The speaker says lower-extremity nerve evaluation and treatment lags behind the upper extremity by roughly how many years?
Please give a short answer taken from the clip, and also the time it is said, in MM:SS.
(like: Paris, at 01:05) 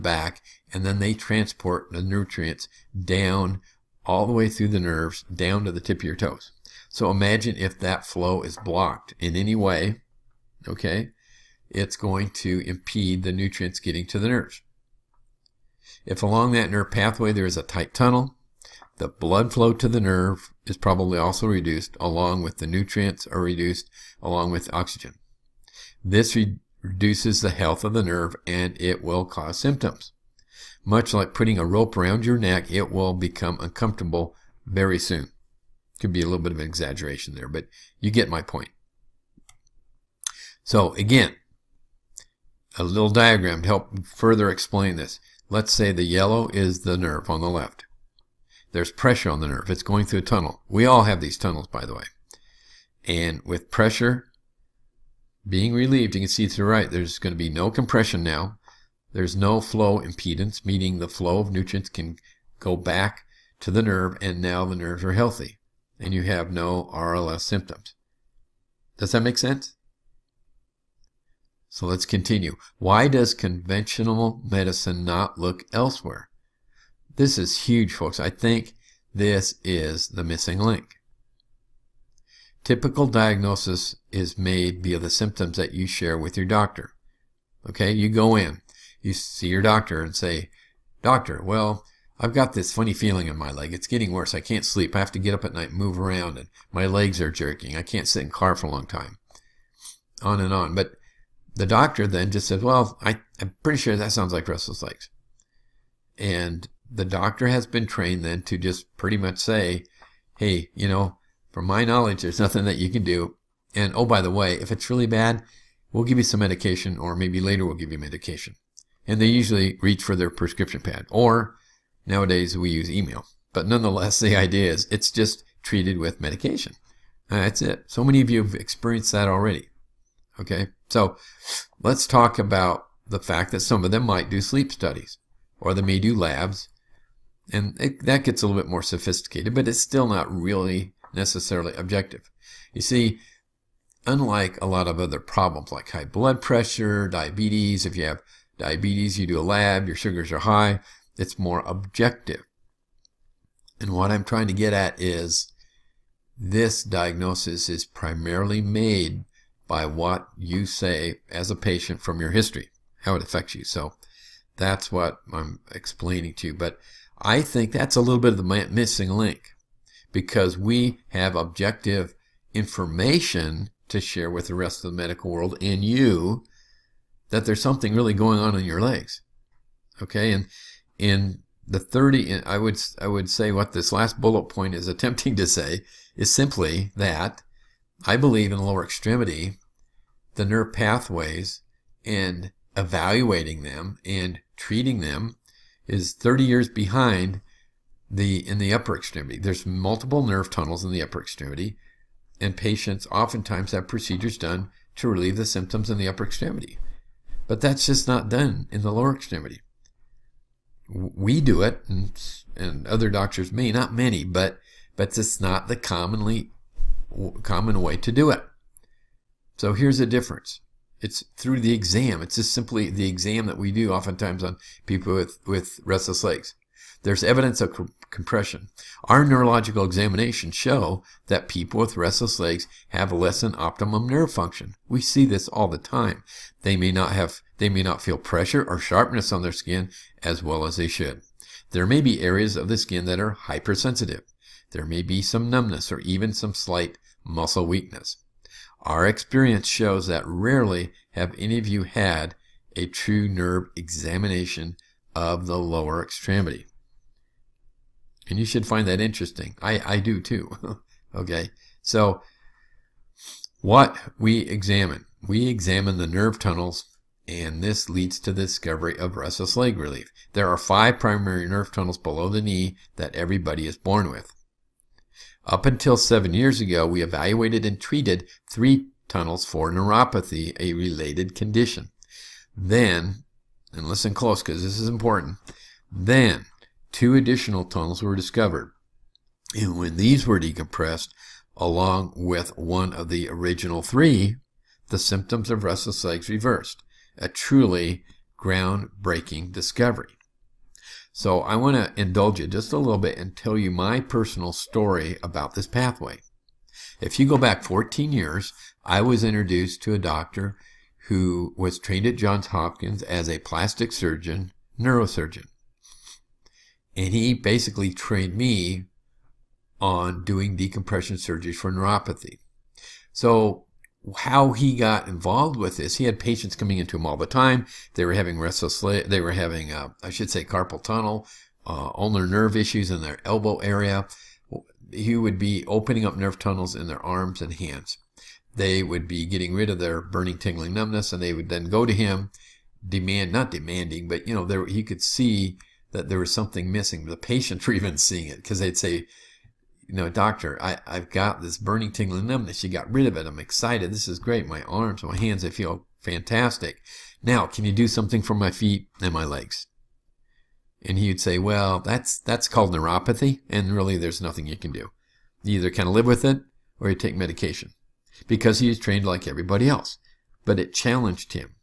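30 years, at 03:16.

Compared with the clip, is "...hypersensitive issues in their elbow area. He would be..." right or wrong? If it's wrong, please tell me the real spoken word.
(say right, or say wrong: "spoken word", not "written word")
wrong: "nerve", not "hypersensitive".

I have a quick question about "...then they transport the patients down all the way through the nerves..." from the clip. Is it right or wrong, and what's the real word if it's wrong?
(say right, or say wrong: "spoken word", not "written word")
wrong: "nutrients", not "patients".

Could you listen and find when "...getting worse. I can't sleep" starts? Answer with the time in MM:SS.
01:33.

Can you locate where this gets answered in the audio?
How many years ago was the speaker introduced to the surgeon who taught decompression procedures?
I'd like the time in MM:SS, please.
05:07.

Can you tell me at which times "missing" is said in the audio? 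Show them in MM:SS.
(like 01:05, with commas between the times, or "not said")
01:20, 02:48, 05:46.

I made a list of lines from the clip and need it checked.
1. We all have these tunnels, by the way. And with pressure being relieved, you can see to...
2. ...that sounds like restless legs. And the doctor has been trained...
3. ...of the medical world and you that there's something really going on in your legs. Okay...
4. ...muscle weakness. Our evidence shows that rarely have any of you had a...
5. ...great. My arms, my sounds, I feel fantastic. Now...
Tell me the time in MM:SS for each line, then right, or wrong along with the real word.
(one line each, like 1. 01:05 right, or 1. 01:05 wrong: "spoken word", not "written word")
1. 00:50 right
2. 01:43 right
3. 02:54 right
4. 04:07 wrong: "experience", not "evidence"
5. 05:54 wrong: "hands", not "sounds".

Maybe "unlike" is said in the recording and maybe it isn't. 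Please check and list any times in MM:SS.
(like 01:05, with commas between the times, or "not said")
02:24.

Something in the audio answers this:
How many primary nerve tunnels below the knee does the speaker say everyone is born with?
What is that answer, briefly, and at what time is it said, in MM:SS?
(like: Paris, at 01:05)
5, at 04:30.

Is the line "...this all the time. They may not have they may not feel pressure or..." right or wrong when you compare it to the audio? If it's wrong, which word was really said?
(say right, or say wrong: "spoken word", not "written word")
right.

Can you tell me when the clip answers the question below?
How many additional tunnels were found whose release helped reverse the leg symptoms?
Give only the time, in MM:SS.
04:46.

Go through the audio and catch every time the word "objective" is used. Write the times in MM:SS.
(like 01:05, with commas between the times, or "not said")
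02:21, 02:31, 02:51.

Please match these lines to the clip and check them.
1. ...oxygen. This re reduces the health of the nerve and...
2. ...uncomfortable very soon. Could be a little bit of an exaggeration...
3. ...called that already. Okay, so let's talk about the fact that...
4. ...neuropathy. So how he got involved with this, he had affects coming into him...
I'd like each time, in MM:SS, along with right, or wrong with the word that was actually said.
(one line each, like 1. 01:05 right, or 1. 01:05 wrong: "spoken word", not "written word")
1. 00:24 right
2. 00:33 right
3. 02:08 wrong: "experienced", not "called"
4. 05:21 wrong: "patients", not "affects".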